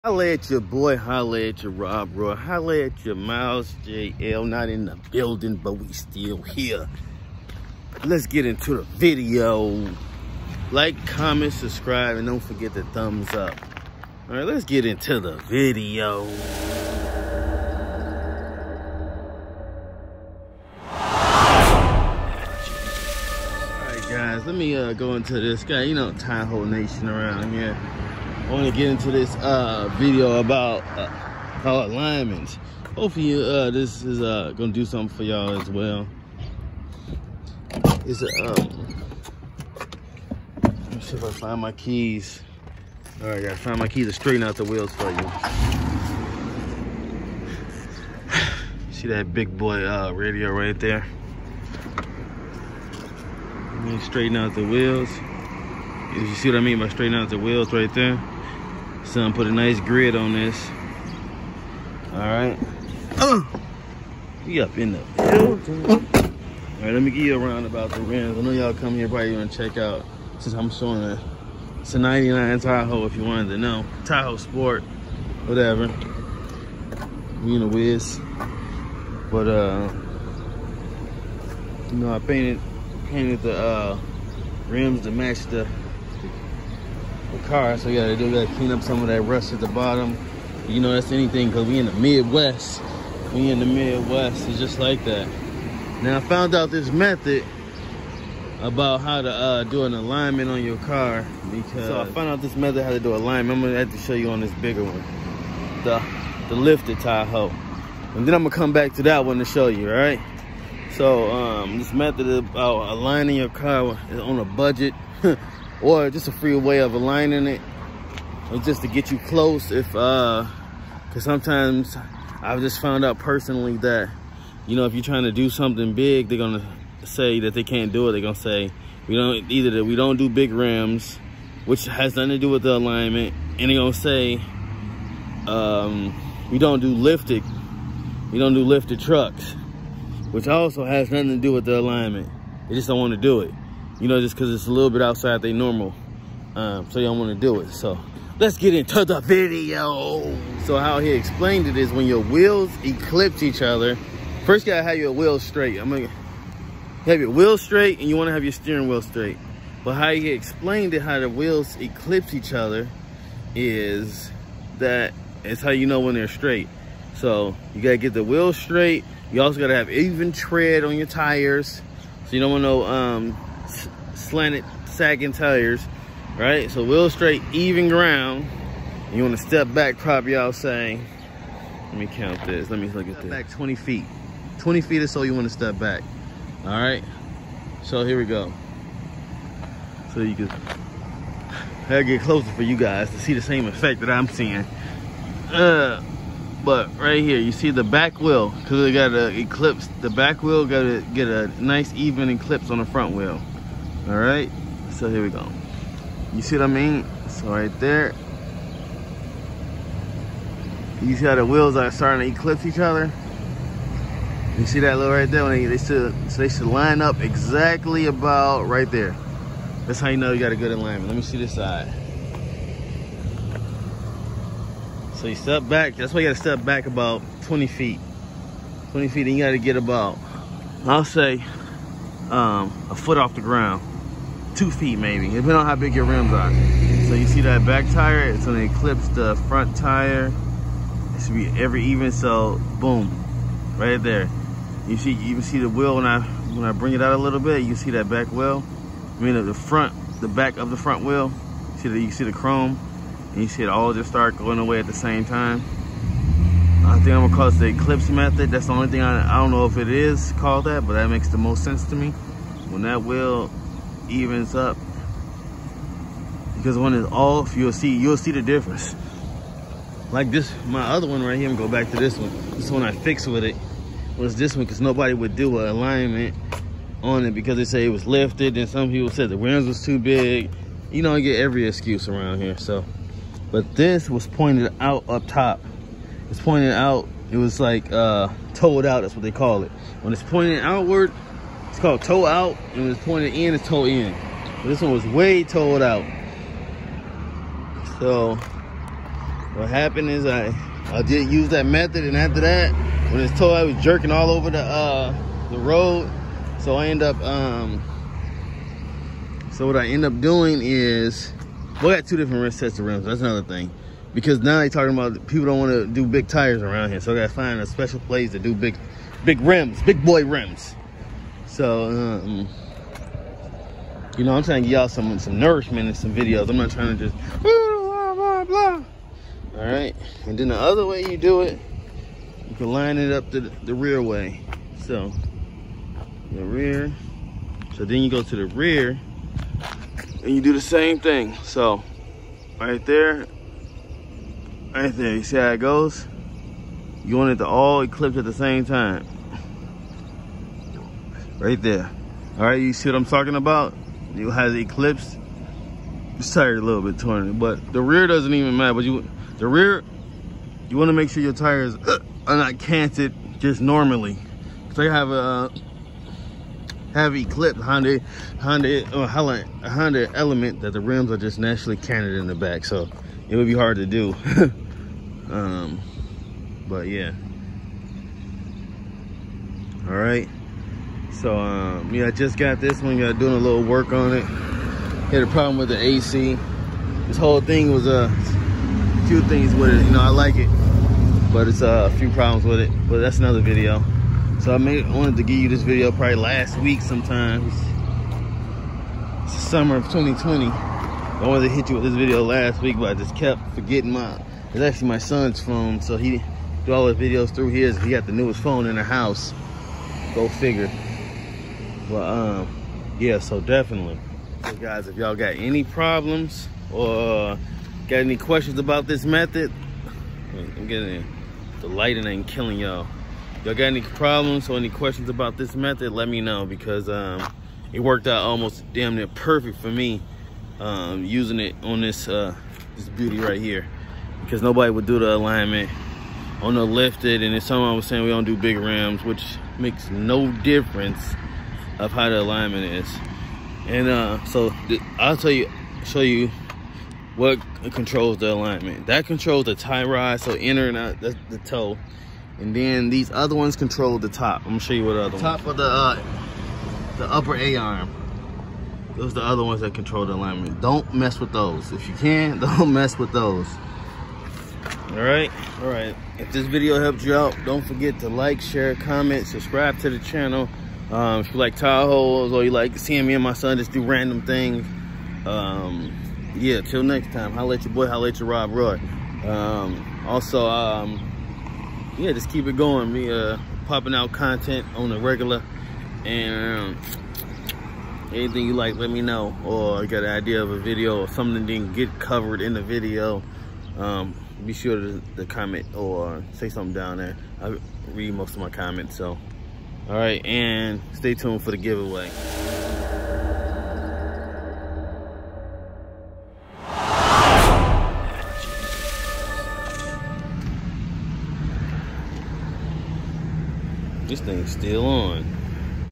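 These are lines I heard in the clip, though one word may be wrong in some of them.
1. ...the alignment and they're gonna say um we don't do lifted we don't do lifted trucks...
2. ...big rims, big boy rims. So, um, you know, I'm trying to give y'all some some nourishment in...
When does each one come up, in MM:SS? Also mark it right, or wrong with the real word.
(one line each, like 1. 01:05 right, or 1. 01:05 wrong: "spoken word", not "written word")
1. 02:12 right
2. 05:19 right.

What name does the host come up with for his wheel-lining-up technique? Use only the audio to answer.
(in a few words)
the eclipse method.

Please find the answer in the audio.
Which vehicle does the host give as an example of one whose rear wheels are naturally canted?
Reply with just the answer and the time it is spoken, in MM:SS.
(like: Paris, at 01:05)
Honda Element, at 06:09.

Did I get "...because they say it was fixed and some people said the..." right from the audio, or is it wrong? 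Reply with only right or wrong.
wrong.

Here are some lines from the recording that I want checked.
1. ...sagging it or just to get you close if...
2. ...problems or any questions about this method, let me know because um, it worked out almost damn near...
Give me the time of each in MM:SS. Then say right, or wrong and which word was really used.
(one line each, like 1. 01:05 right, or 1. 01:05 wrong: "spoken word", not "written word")
1. 01:56 wrong: "aligning", not "sagging"
2. 07:03 right.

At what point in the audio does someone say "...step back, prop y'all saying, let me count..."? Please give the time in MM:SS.
02:59.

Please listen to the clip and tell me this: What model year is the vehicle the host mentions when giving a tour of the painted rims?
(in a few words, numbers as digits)
1999.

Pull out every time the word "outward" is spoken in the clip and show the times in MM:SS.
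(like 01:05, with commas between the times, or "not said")
04:50.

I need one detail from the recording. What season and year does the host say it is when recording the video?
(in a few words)
summer of 2020.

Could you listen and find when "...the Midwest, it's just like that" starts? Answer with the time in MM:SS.
01:33.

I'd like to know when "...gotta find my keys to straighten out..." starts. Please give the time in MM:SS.
00:43.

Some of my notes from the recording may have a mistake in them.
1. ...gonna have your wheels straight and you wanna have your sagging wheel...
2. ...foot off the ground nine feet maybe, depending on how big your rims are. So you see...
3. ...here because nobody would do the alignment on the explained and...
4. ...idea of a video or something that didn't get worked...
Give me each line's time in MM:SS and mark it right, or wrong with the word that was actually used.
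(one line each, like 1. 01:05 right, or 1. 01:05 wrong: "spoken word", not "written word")
1. 02:35 wrong: "steering", not "sagging"
2. 03:52 wrong: "two", not "nine"
3. 07:13 wrong: "lifted", not "explained"
4. 08:10 wrong: "covered", not "worked".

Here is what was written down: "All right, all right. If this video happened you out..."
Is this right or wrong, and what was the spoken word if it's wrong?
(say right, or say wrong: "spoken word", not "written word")
wrong: "helped", not "happened".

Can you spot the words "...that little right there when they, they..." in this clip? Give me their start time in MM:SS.
03:34.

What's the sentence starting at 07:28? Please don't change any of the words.
That controls the tie rod, so inner and out, the toe.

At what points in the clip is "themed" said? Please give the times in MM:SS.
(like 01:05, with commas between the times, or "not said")
not said.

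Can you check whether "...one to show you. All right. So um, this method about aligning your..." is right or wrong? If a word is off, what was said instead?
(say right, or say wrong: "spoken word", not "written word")
right.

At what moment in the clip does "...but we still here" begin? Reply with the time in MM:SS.
00:05.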